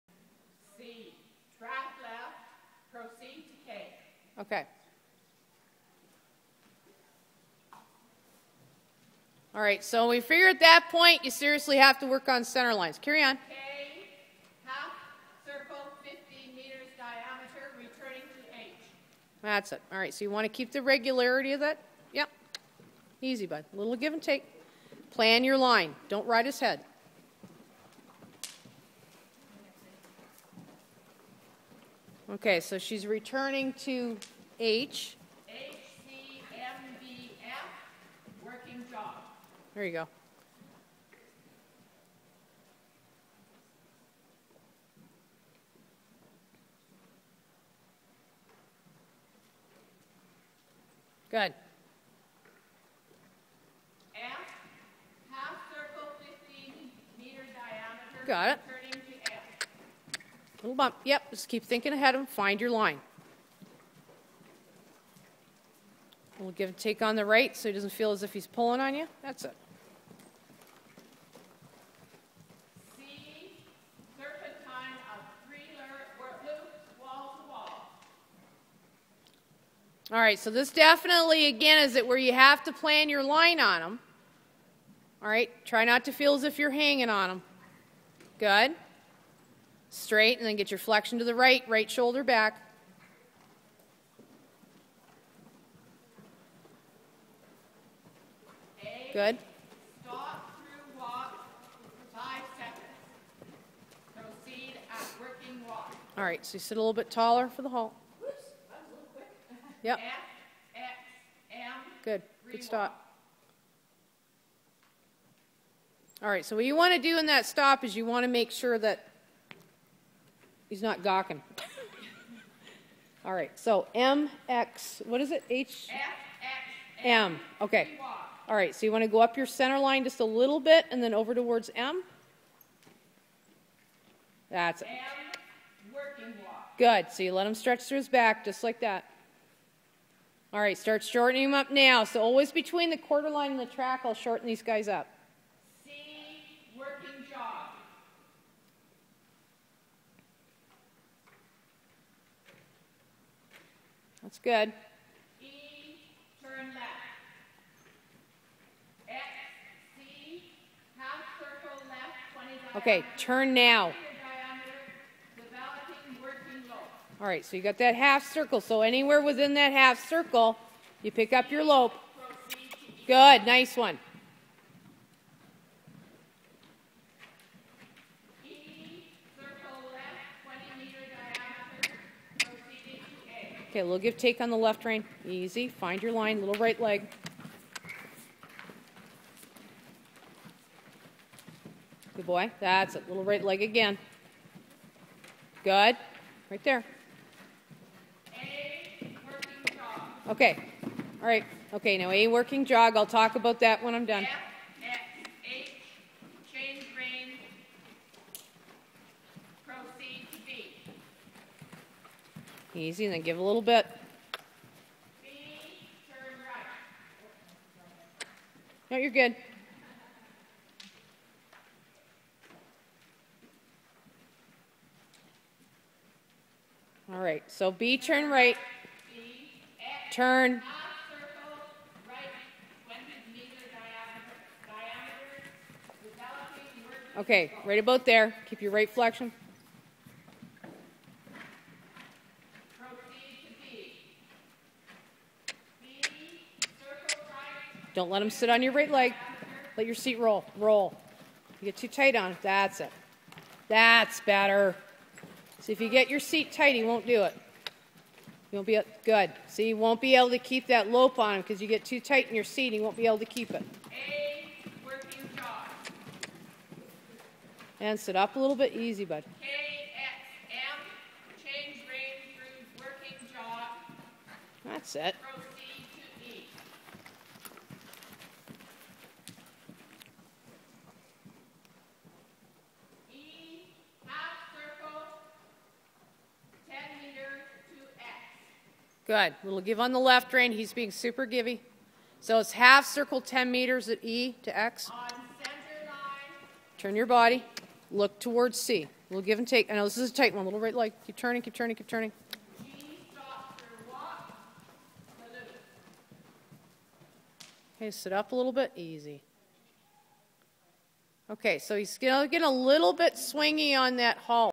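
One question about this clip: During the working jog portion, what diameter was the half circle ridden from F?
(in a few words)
15 meters.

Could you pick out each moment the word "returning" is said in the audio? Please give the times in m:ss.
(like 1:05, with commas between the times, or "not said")
0:17, 0:33.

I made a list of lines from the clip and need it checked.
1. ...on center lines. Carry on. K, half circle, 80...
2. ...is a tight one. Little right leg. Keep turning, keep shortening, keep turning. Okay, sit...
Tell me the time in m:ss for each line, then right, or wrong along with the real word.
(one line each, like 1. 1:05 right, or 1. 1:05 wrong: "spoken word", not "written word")
1. 0:12 wrong: "50", not "80"
2. 4:59 wrong: "turning", not "shortening".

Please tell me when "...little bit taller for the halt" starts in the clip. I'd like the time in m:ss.
1:46.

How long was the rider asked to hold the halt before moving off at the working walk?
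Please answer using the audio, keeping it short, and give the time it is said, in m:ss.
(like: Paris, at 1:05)
5 seconds, at 1:42.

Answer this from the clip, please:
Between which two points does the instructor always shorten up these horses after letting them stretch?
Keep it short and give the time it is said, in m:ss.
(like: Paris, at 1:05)
quarter line and the track, at 2:22.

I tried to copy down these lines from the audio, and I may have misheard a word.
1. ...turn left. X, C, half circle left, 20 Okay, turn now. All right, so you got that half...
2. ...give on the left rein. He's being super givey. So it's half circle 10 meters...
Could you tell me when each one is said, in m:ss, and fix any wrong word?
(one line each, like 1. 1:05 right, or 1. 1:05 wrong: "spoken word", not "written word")
1. 2:36 right
2. 4:49 right.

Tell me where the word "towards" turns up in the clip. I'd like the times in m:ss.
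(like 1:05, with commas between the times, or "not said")
2:11, 4:58.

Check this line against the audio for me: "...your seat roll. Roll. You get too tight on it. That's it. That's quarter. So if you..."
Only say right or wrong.
wrong.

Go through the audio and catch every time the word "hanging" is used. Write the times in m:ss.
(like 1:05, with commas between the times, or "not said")
1:26.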